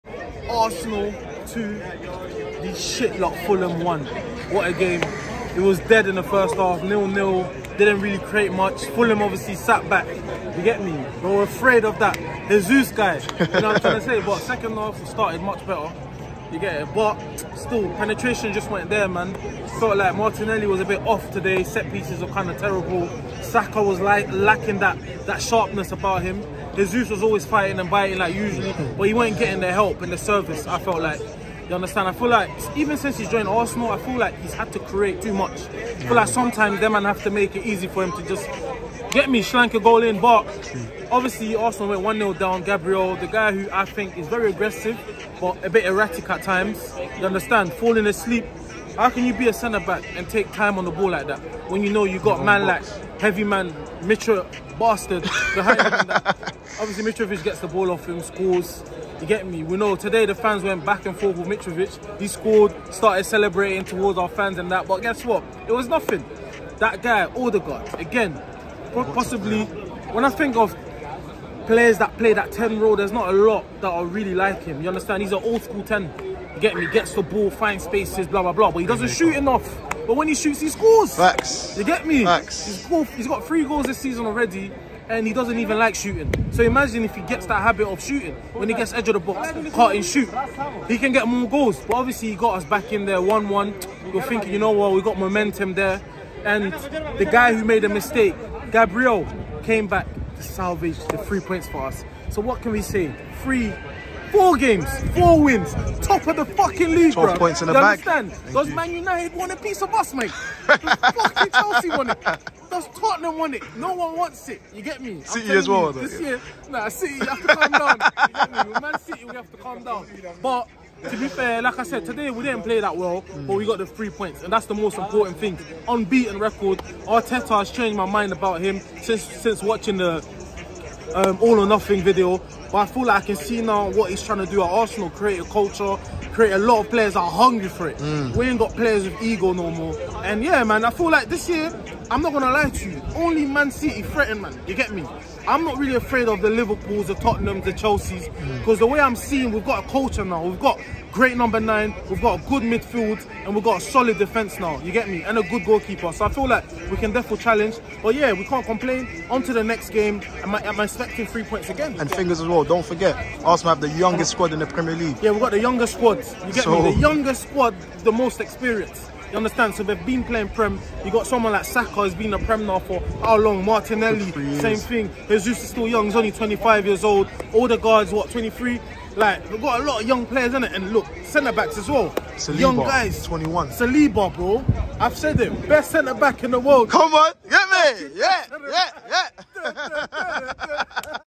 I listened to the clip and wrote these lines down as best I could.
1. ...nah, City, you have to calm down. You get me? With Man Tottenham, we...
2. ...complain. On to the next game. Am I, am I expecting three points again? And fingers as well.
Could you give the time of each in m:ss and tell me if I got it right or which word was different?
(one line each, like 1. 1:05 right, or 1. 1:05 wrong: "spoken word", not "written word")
1. 1:56 wrong: "City", not "Tottenham"
2. 2:38 right.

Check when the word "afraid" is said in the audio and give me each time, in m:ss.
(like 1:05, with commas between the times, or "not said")
0:11, 2:25.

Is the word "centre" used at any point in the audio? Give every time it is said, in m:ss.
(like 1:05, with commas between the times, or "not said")
0:49, 3:01, 3:05.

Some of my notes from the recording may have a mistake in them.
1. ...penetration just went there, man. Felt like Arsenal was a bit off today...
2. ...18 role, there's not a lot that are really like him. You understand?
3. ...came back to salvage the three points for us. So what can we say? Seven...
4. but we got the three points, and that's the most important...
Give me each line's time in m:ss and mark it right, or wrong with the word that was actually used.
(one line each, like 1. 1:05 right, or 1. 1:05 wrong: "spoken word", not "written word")
1. 0:17 wrong: "Martinelli", not "Arsenal"
2. 1:12 wrong: "10", not "18"
3. 1:39 wrong: "Three", not "Seven"
4. 2:03 right.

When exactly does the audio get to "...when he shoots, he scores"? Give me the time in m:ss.
1:20.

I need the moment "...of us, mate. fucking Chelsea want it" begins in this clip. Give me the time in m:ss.
1:49.